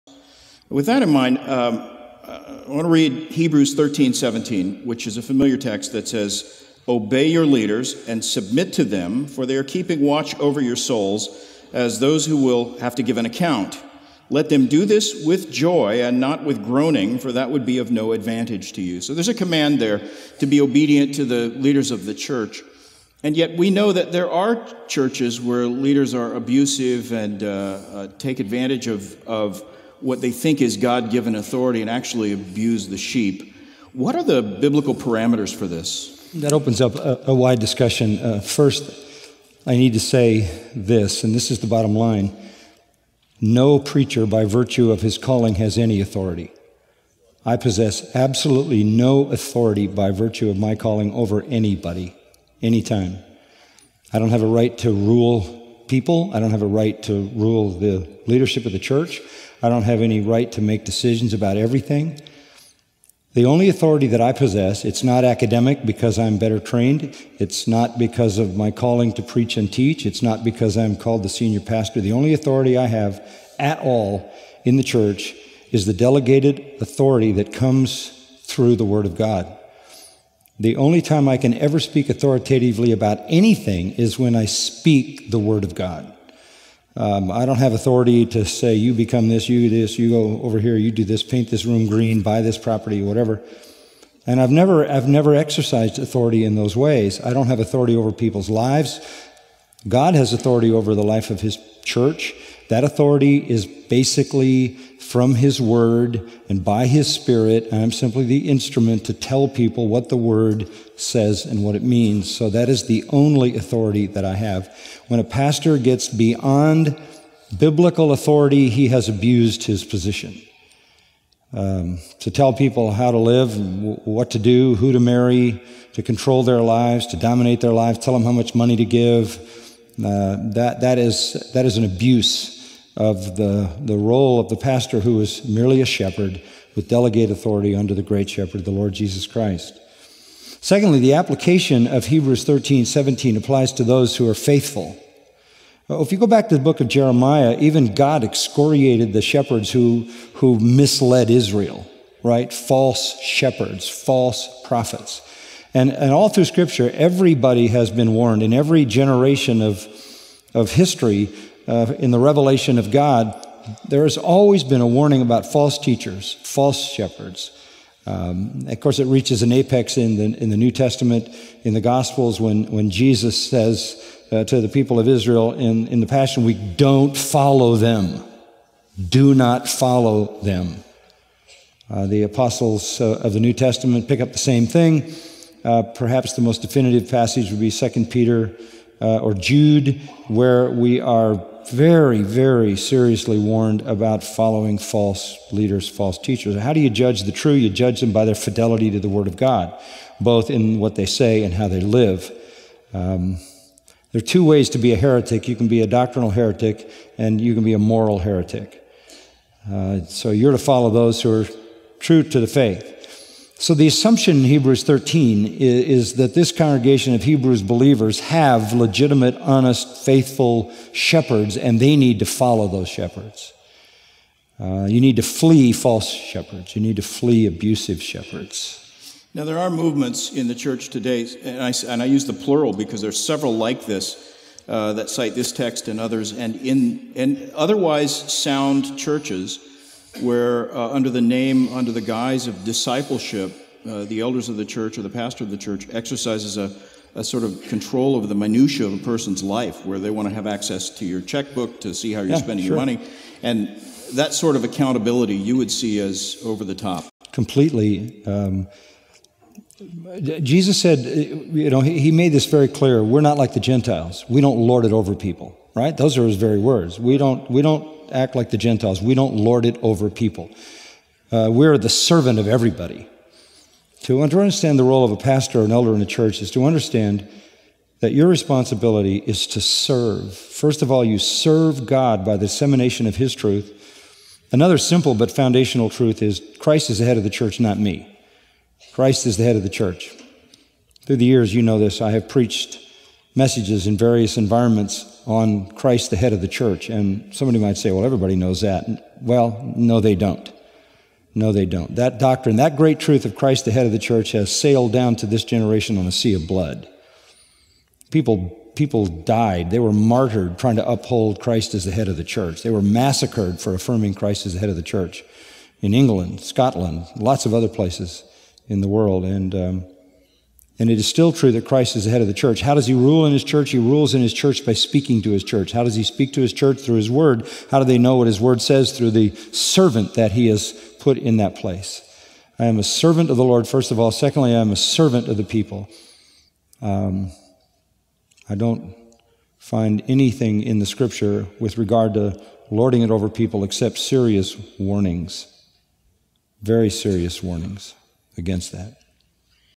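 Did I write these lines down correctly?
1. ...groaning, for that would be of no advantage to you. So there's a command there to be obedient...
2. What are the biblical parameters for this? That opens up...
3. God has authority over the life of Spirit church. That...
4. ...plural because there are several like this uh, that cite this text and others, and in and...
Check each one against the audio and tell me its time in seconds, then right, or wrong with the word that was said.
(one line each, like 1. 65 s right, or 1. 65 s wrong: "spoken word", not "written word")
1. 16 s right
2. 33 s right
3. 99 s wrong: "His", not "Spirit"
4. 232 s right.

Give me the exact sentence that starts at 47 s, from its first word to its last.
I possess absolutely no authority by virtue of my calling over anybody, anytime.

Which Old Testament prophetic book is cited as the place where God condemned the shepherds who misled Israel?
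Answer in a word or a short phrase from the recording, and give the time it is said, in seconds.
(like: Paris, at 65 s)
Jeremiah, at 146 s.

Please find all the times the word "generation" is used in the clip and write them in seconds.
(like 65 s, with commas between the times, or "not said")
158 s, 305 s.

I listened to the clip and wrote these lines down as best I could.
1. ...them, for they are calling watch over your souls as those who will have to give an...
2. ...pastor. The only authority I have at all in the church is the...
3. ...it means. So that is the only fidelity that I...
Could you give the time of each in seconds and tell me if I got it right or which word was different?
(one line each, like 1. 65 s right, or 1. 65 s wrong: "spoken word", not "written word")
1. 8 s wrong: "keeping", not "calling"
2. 71 s right
3. 111 s wrong: "authority", not "fidelity".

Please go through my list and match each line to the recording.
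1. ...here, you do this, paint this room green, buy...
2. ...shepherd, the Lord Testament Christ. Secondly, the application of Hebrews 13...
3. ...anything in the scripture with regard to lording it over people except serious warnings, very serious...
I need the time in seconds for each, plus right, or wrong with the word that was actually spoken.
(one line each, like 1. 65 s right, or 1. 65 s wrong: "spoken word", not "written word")
1. 90 s right
2. 138 s wrong: "Jesus", not "Testament"
3. 340 s right.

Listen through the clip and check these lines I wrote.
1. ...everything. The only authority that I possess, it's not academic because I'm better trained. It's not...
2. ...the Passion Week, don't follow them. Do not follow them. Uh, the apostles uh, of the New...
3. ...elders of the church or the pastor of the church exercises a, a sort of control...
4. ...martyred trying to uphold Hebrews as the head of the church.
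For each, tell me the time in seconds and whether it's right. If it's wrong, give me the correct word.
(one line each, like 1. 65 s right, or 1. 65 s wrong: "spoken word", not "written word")
1. 61 s right
2. 175 s right
3. 244 s right
4. 309 s wrong: "Christ", not "Hebrews".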